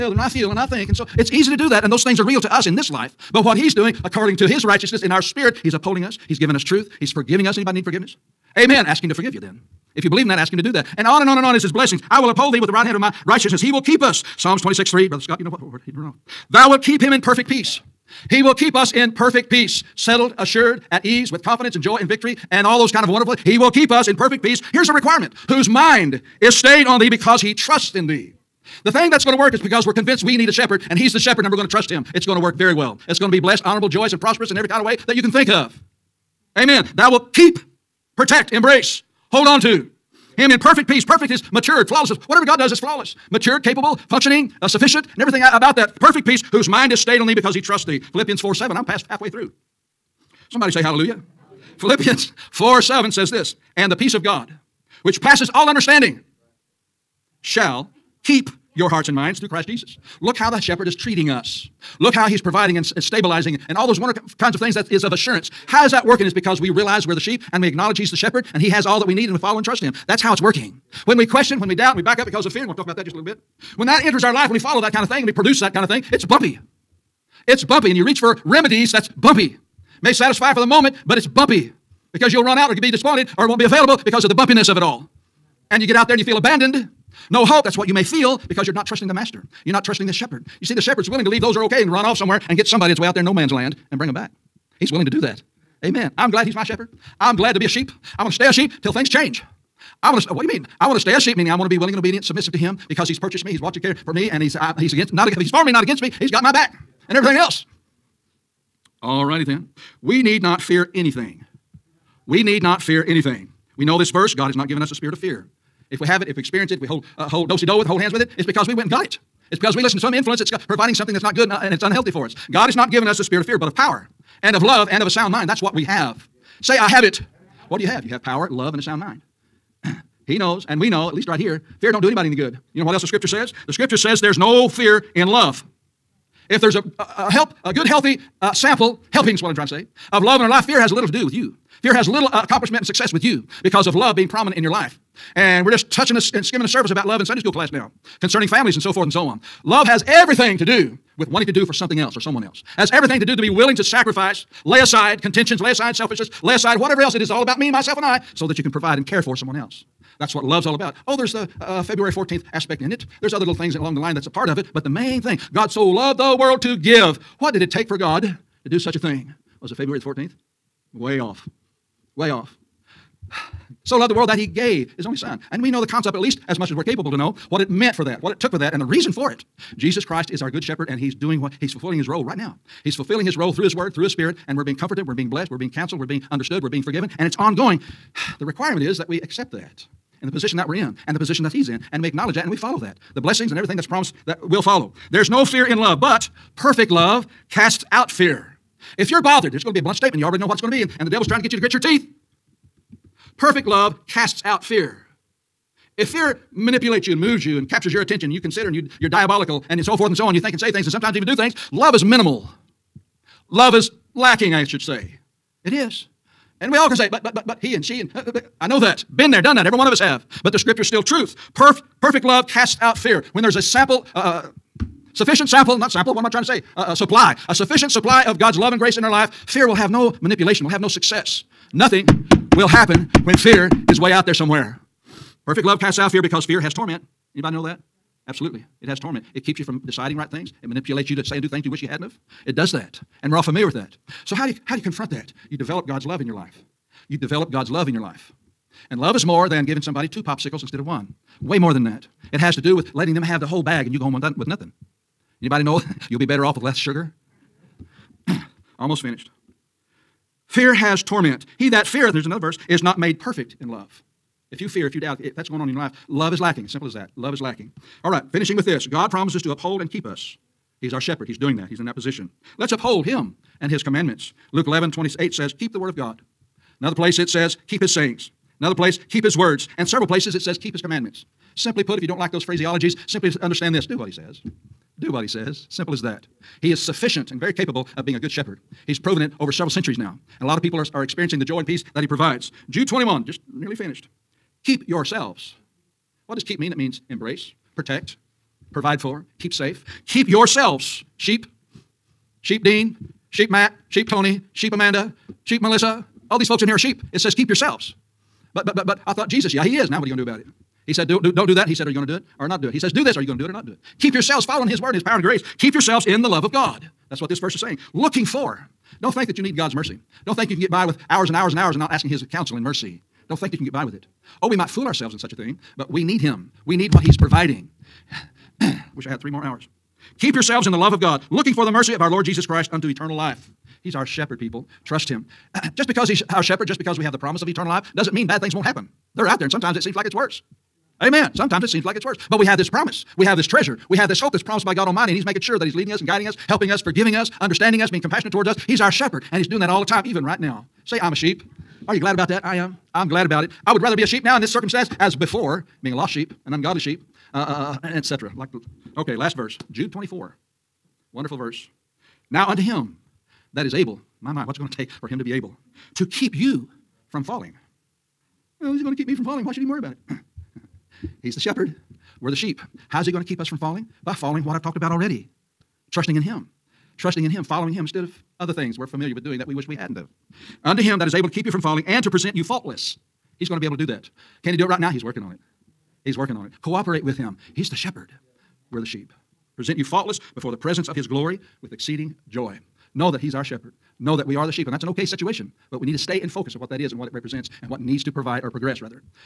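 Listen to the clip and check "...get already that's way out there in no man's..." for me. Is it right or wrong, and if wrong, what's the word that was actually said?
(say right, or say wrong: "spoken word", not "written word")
wrong: "somebody", not "already".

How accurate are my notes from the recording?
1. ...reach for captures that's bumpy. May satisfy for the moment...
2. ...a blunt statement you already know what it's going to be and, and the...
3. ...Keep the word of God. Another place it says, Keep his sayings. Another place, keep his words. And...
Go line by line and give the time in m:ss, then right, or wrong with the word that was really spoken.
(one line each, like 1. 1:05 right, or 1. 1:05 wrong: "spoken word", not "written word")
1. 1:18 wrong: "remedies", not "captures"
2. 3:19 right
3. 4:35 right.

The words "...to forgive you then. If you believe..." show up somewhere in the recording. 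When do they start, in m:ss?
0:09.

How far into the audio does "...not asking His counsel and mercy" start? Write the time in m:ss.
5:21.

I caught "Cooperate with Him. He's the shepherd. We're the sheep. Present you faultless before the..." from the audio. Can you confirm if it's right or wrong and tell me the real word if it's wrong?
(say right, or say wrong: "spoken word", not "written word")
right.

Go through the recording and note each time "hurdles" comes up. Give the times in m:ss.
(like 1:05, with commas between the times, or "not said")
not said.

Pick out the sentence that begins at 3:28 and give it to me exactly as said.
You consider and you, you're diabolical and so forth and so on.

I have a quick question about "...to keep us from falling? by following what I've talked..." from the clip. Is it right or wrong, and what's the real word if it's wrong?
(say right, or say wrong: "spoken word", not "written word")
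right.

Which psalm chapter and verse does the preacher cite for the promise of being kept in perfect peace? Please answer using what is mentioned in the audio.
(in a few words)
Psalms 26:3.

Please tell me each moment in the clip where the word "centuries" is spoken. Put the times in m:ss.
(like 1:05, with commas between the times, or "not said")
4:49.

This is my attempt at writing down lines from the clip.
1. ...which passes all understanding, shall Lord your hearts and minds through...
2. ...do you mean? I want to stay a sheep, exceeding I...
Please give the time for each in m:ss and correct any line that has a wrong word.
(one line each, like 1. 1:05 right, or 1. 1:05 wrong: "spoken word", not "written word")
1. 0:55 wrong: "Keep", not "Lord"
2. 1:40 wrong: "meaning", not "exceeding".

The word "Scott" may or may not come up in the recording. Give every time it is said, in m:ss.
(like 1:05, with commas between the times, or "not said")
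0:15.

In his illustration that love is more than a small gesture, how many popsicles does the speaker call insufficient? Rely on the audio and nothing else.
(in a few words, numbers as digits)
2.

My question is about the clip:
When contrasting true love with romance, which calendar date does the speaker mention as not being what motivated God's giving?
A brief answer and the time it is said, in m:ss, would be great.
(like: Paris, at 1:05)
February 14th, at 2:41.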